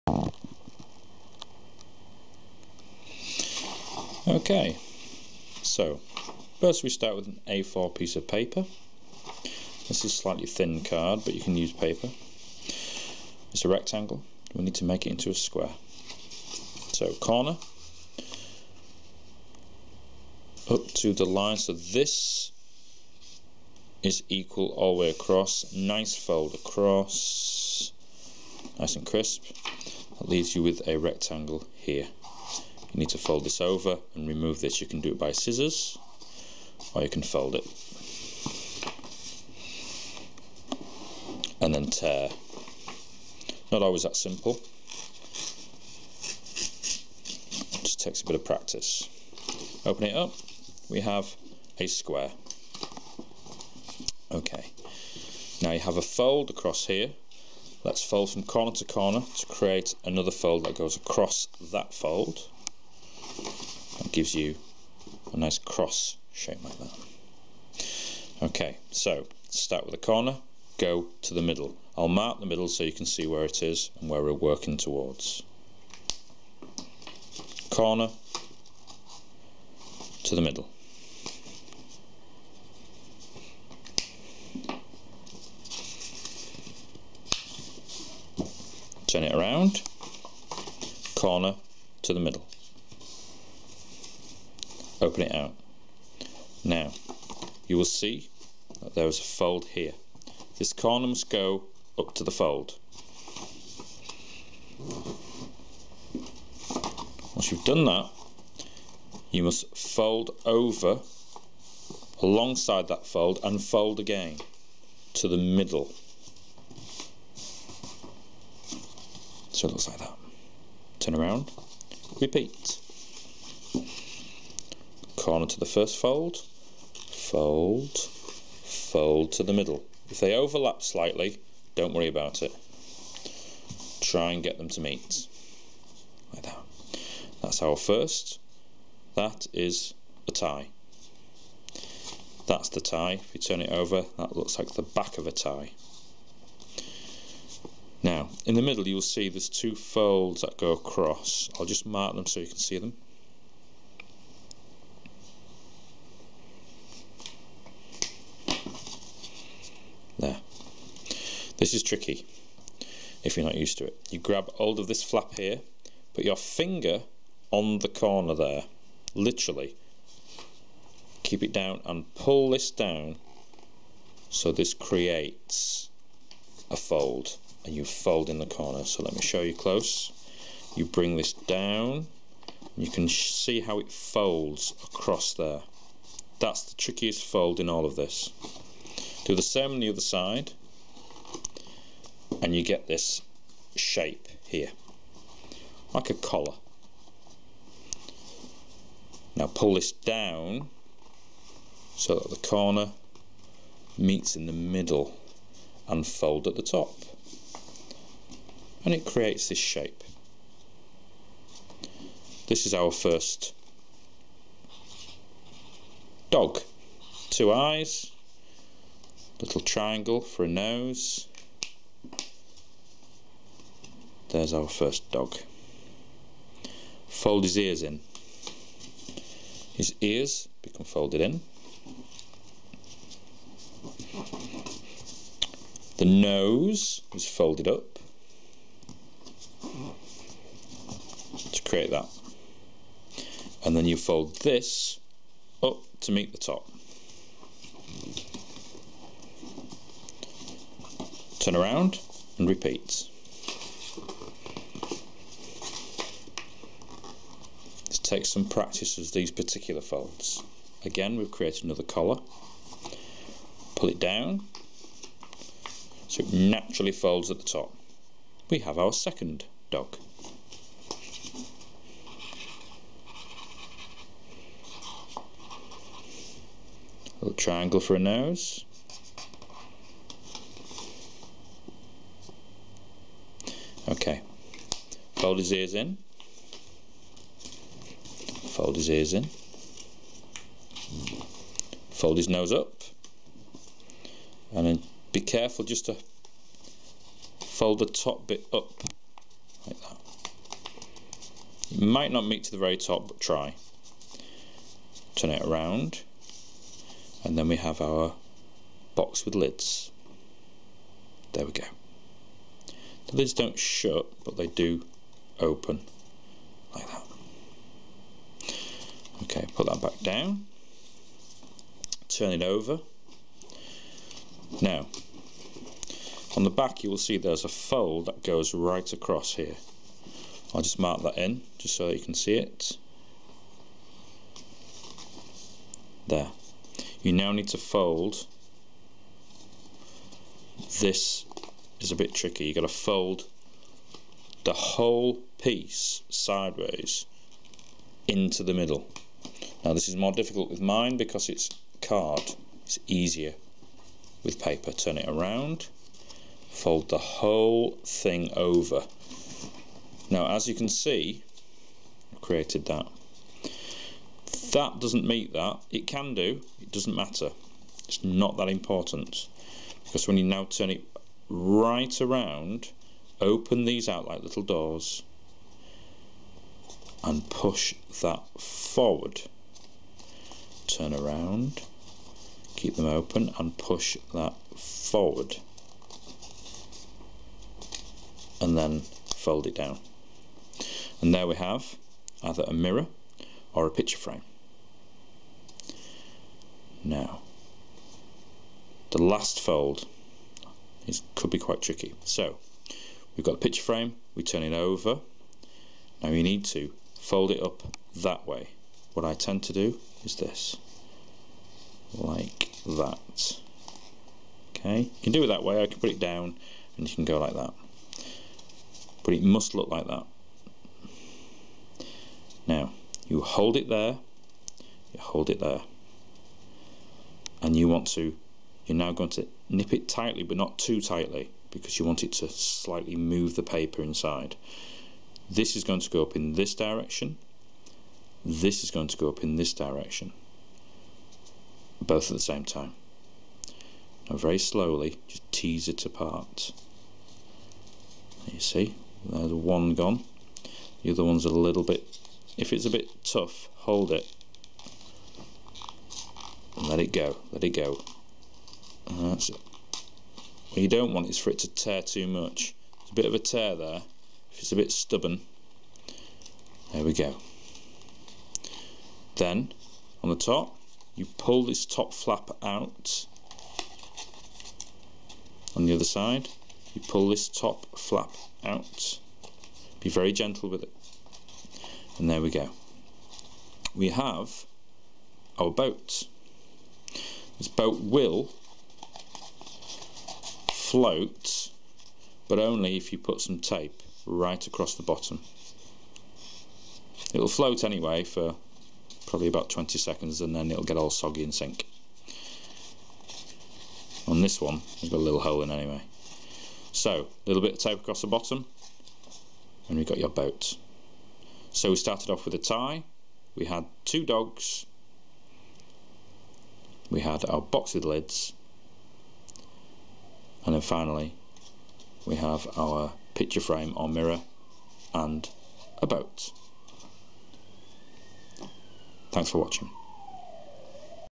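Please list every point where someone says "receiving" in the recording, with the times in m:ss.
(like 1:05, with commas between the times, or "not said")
not said.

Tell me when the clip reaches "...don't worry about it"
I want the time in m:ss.
2:11.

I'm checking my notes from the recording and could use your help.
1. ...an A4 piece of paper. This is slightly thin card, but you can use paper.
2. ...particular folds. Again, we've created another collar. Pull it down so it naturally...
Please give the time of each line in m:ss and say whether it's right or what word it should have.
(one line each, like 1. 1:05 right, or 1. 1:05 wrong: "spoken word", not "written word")
1. 0:07 right
2. 4:19 right.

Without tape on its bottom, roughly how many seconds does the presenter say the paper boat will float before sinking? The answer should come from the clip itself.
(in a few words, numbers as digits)
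20 seconds.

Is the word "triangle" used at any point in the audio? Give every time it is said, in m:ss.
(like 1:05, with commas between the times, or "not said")
3:39, 4:37.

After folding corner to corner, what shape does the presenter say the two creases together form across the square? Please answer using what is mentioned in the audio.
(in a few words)
cross shape.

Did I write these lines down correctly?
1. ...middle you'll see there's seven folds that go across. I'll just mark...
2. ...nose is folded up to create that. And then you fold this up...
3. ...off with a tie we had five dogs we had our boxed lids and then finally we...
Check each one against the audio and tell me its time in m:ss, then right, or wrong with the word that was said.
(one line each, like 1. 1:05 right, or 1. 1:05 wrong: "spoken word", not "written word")
1. 2:28 wrong: "two", not "seven"
2. 3:56 right
3. 8:32 wrong: "two", not "five".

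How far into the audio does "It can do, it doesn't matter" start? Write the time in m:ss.
6:05.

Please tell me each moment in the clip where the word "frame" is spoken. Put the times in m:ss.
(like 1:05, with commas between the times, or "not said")
6:33, 6:43, 8:43.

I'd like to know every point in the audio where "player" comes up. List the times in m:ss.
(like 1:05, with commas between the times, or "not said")
not said.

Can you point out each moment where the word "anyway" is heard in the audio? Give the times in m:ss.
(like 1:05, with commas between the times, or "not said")
8:17, 8:25.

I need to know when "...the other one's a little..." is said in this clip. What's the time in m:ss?
7:30.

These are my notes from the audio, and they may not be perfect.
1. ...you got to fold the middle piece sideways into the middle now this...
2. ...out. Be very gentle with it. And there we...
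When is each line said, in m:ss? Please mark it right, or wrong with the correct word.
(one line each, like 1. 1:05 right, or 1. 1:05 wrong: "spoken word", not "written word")
1. 5:42 wrong: "whole", not "middle"
2. 7:58 right.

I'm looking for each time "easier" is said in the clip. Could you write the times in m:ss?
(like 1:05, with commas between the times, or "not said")
5:52.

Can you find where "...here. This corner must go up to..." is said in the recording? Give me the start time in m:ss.
1:39.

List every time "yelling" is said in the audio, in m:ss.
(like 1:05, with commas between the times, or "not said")
not said.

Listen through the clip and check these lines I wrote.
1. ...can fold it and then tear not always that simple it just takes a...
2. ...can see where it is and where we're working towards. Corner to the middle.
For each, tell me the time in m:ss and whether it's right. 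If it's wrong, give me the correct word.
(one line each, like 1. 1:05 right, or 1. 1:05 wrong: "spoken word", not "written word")
1. 0:37 right
2. 1:12 right.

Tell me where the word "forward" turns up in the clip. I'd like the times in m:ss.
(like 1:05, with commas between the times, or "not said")
6:18, 6:24.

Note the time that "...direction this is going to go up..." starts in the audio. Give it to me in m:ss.
7:16.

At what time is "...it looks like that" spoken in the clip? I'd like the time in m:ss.
1:59.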